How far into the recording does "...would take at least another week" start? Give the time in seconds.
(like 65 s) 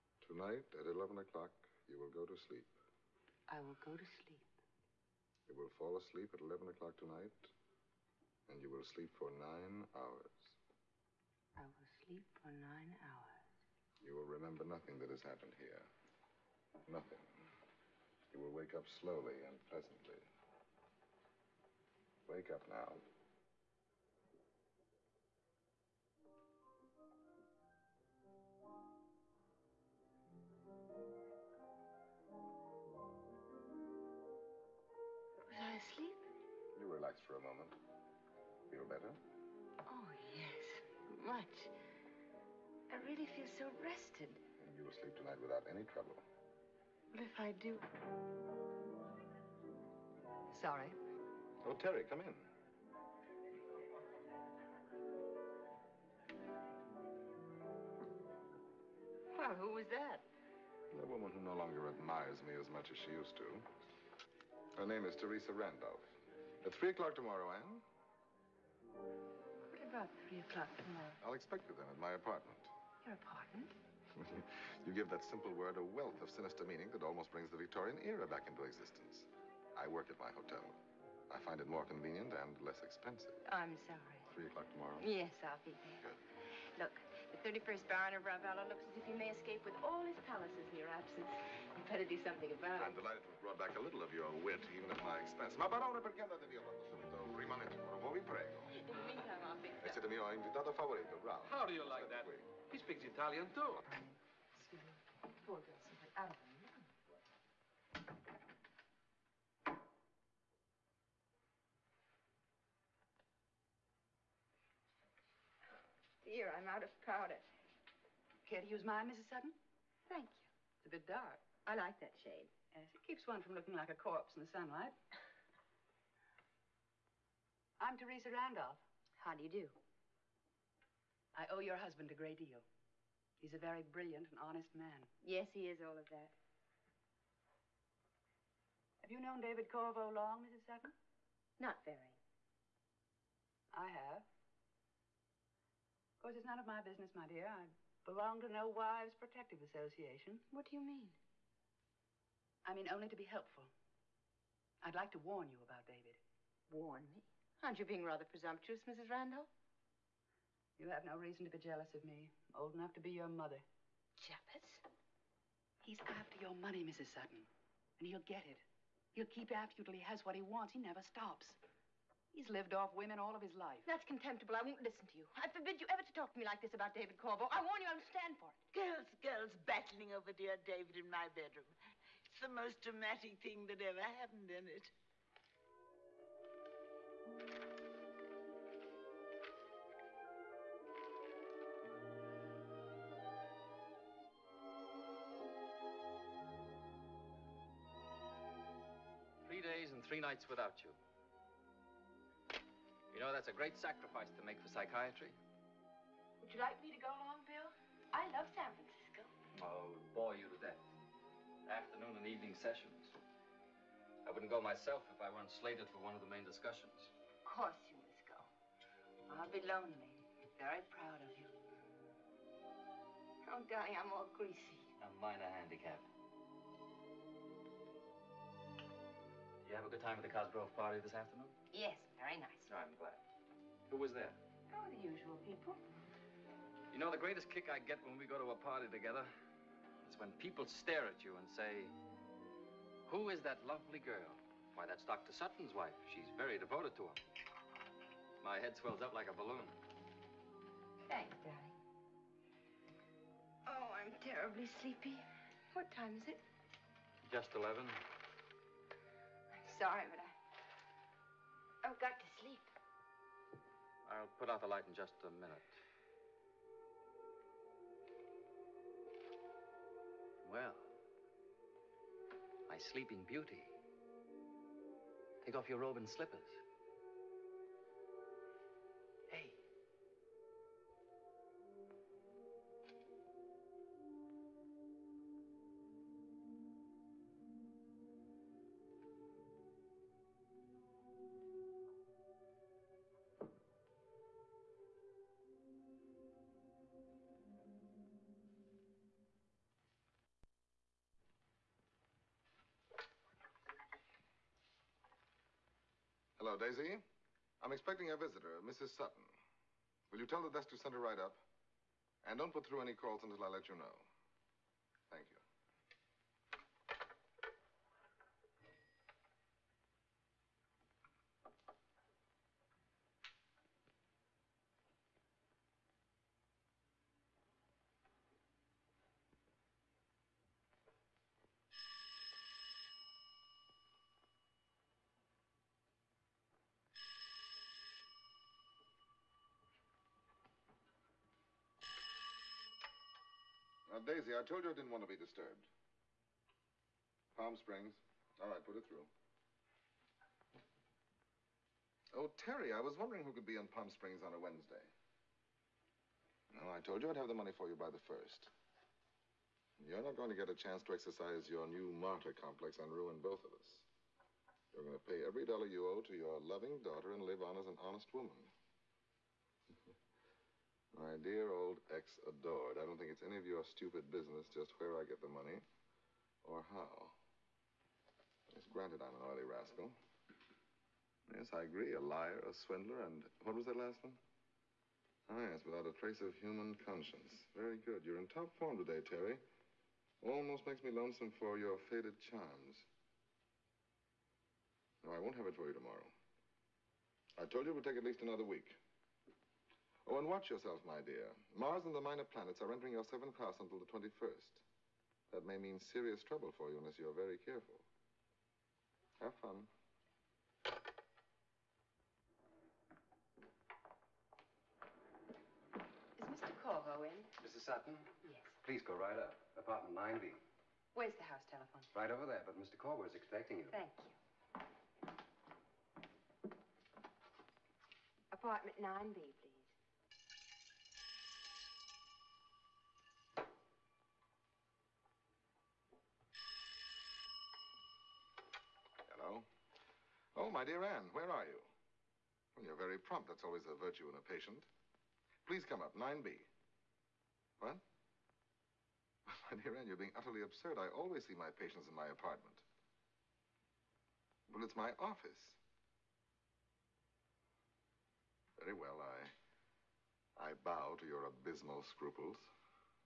397 s.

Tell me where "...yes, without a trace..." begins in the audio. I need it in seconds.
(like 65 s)
385 s.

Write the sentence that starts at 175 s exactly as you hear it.
I forbid you ever to talk to me like this about David Korvo.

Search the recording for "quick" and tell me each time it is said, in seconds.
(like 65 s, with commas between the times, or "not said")
not said.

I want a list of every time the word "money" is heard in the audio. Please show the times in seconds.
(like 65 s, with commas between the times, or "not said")
166 s, 357 s, 375 s.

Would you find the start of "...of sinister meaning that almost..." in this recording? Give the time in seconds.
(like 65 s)
76 s.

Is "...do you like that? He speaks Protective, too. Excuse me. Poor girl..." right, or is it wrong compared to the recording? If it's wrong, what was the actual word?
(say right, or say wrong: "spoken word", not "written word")
wrong: "Italian", not "Protective".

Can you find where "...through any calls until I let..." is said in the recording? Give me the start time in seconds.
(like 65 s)
312 s.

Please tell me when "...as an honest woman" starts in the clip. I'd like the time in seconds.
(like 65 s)
367 s.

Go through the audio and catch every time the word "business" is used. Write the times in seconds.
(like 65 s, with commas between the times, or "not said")
146 s, 374 s.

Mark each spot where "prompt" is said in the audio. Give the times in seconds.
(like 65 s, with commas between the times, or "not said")
442 s.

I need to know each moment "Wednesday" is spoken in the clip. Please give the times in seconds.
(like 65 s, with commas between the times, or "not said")
354 s.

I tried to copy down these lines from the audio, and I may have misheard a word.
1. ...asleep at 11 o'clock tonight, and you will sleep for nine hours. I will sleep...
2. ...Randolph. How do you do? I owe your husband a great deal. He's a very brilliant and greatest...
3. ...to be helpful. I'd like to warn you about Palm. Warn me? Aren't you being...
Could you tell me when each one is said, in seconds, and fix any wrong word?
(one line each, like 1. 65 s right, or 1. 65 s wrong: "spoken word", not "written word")
1. 5 s right
2. 128 s wrong: "honest", not "greatest"
3. 153 s wrong: "David", not "Palm".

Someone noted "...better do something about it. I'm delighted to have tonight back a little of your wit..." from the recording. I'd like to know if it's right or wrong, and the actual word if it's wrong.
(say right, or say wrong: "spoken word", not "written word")
wrong: "brought", not "tonight".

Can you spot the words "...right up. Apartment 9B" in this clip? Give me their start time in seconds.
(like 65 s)
418 s.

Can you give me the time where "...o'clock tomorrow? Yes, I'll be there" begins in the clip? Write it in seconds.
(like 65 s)
84 s.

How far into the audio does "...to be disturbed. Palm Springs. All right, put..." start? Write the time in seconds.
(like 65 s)
345 s.